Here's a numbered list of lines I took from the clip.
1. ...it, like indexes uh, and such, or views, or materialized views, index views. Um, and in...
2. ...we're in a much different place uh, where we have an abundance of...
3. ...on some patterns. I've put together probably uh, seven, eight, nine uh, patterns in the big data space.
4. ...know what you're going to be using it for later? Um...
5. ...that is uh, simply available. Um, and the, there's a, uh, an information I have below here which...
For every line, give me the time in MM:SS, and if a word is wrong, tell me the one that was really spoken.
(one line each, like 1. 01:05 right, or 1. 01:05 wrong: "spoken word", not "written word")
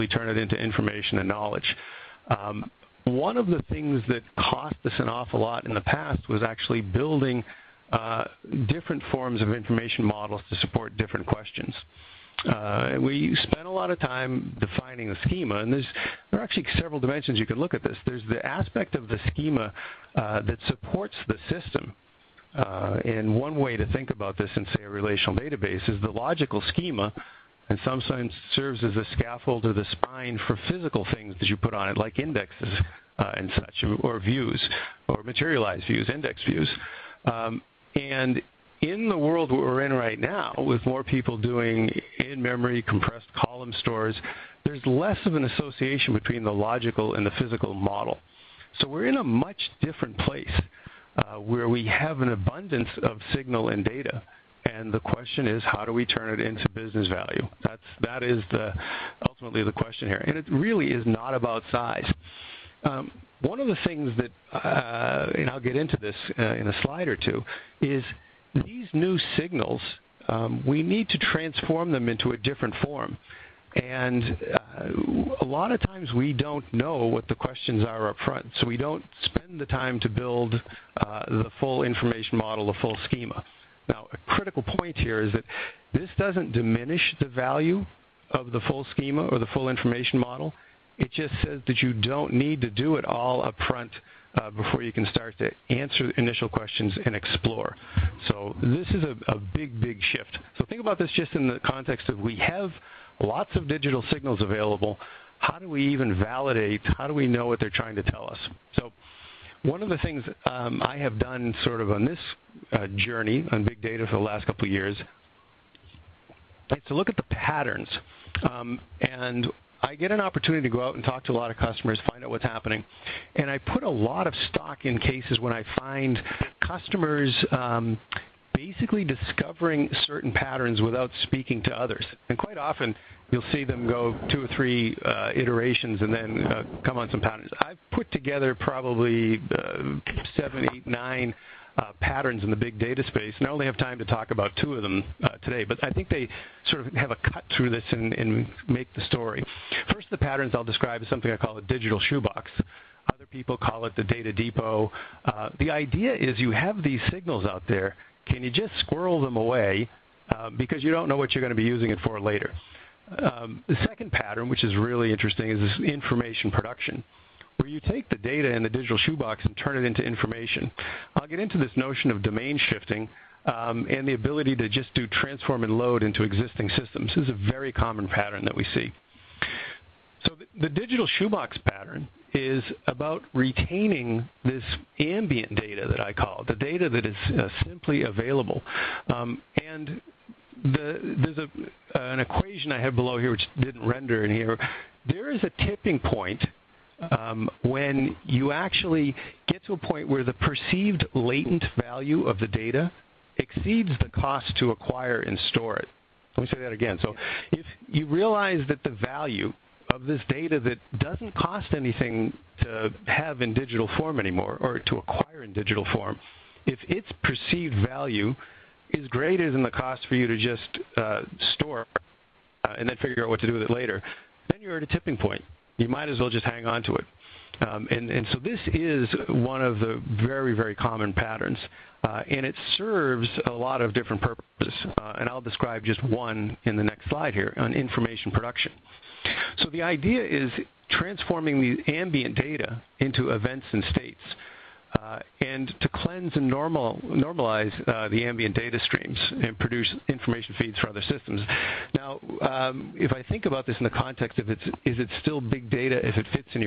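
1. 00:31 right
2. 00:48 right
3. 02:16 right
4. 02:41 right
5. 03:06 wrong: "equation", not "information".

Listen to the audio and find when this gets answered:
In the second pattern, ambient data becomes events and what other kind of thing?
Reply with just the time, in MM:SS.
04:03.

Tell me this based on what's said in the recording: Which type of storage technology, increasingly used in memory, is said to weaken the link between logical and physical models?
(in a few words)
compressed column stores.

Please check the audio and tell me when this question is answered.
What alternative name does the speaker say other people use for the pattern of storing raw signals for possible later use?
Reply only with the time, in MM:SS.
02:34.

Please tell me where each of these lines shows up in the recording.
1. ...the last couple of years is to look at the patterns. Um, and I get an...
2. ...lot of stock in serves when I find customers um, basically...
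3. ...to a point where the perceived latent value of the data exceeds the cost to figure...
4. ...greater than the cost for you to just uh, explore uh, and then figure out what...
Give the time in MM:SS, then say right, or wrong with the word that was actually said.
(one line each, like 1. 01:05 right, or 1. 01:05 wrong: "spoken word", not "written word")
1. 01:54 right
2. 02:03 wrong: "cases", not "serves"
3. 03:19 wrong: "acquire", not "figure"
4. 03:39 wrong: "store", not "explore".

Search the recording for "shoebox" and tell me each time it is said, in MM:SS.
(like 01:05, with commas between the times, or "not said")
02:31, 02:48, 03:01.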